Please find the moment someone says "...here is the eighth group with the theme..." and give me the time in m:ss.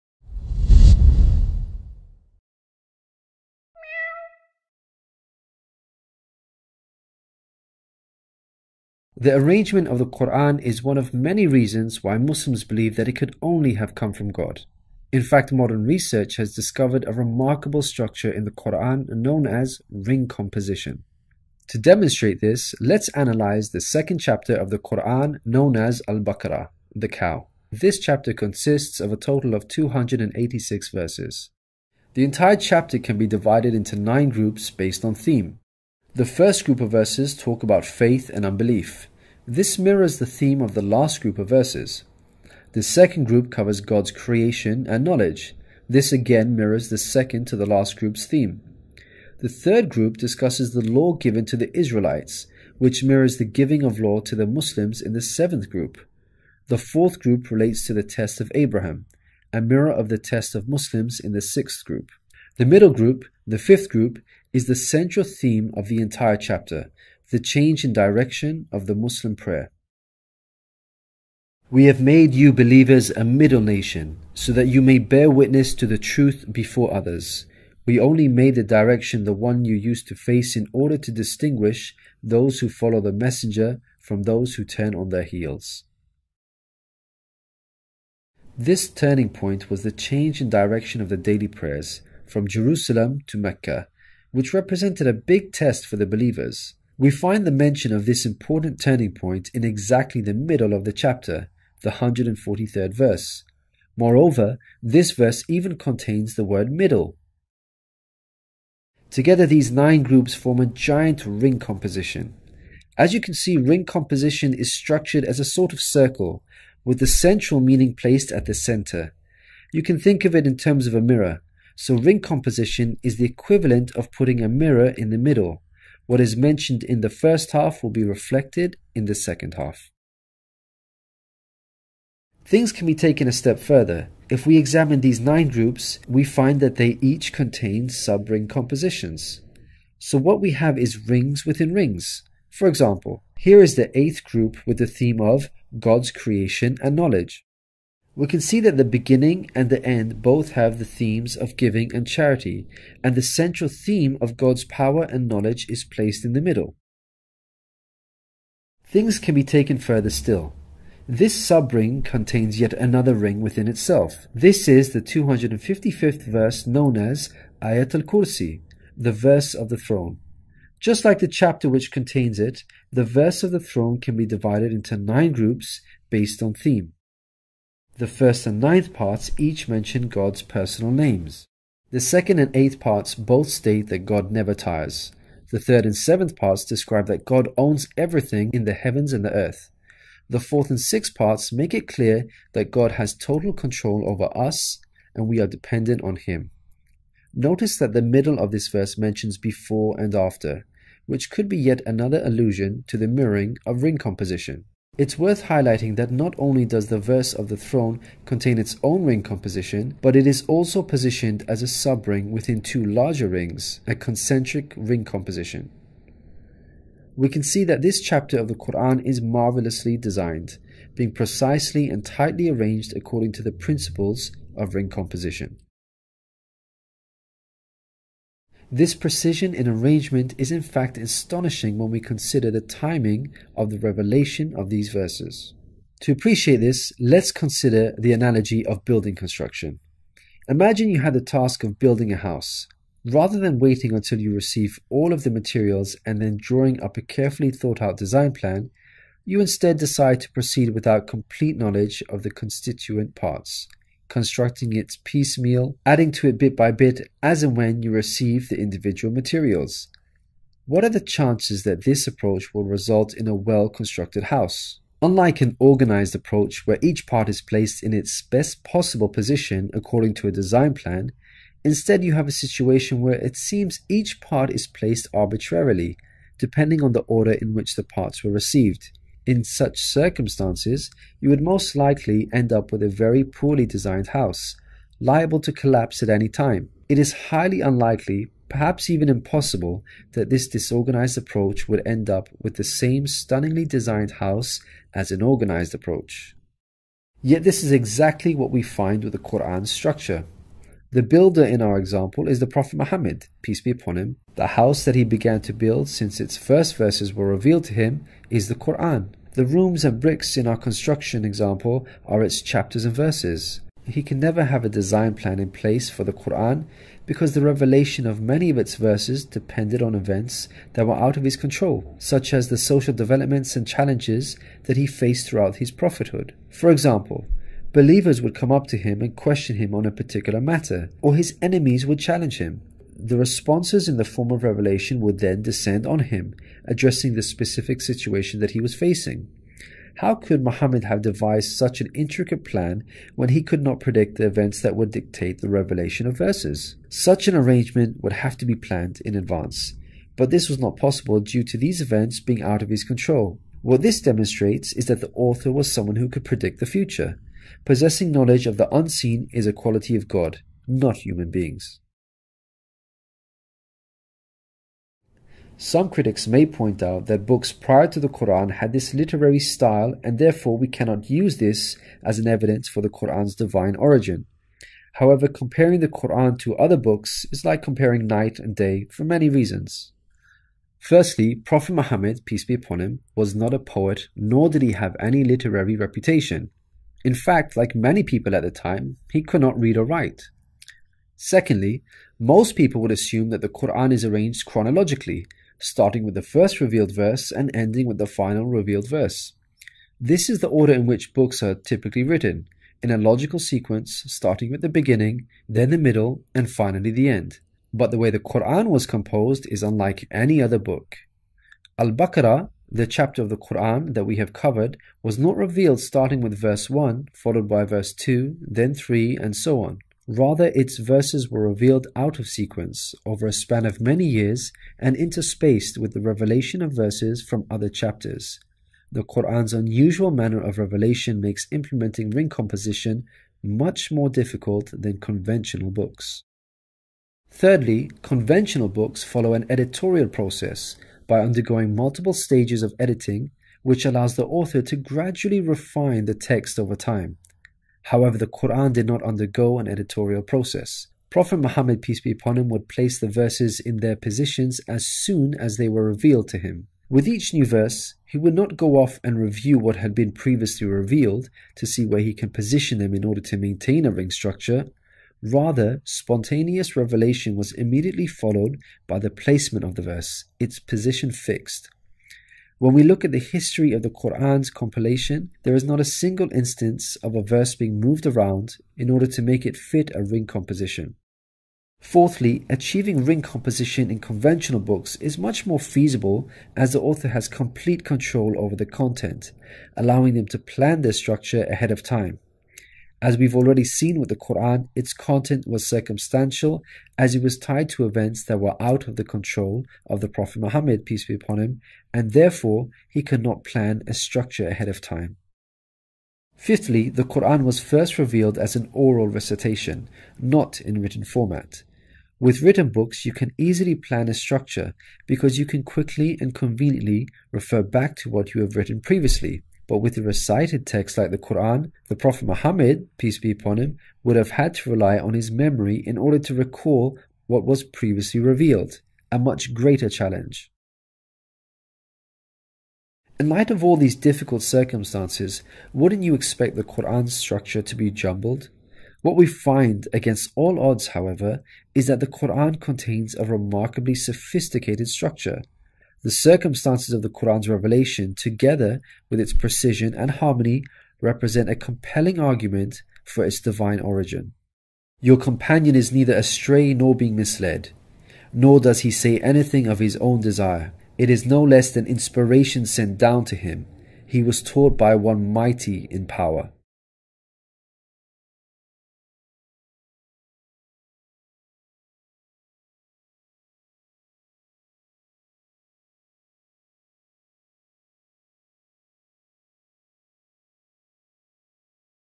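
2:23.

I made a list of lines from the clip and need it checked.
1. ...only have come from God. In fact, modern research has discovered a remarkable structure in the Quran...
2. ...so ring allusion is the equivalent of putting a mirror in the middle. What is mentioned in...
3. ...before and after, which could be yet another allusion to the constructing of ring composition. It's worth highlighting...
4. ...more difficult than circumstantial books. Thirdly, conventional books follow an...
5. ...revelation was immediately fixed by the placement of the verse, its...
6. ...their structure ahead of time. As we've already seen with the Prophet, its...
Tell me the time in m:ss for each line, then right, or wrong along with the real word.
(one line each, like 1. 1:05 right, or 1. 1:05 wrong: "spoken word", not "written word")
1. 0:13 right
2. 2:01 wrong: "composition", not "allusion"
3. 3:19 wrong: "mirroring", not "constructing"
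4. 7:13 wrong: "conventional", not "circumstantial"
5. 7:46 wrong: "followed", not "fixed"
6. 8:10 wrong: "Quran", not "Prophet".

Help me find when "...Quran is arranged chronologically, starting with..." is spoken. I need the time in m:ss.
6:33.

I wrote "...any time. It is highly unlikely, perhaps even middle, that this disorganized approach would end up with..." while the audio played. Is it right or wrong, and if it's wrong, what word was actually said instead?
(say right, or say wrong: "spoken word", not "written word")
wrong: "impossible", not "middle".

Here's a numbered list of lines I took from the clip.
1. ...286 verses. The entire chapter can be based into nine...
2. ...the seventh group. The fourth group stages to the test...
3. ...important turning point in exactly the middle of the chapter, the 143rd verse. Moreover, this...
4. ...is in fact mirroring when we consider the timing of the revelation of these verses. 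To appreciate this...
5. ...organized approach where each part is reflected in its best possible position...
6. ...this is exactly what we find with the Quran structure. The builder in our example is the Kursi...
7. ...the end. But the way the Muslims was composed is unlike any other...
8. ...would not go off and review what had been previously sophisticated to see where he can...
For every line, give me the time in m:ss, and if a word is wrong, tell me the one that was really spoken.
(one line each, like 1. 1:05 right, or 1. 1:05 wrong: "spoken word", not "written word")
1. 0:29 wrong: "divided", not "based"
2. 0:55 wrong: "relates", not "stages"
3. 1:38 right
4. 3:50 wrong: "astonishing", not "mirroring"
5. 4:25 wrong: "placed", not "reflected"
6. 4:57 wrong: "Prophet", not "Kursi"
7. 6:46 wrong: "Quran", not "Muslims"
8. 7:38 wrong: "revealed", not "sophisticated".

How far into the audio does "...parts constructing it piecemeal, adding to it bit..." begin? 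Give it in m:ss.
4:13.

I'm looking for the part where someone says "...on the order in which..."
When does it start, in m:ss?
4:36.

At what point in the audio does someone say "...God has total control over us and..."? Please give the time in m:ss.
3:12.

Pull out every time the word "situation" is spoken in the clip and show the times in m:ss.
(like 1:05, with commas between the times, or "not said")
4:32, 5:37.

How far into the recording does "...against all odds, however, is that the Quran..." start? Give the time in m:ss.
8:59.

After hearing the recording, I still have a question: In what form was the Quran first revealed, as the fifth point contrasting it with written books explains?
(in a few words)
Oral recitation.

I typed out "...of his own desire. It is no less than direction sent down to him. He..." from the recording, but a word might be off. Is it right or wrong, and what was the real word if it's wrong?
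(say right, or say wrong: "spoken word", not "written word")
wrong: "inspiration", not "direction".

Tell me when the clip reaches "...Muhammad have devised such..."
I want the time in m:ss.
5:40.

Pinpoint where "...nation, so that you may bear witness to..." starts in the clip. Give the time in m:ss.
1:13.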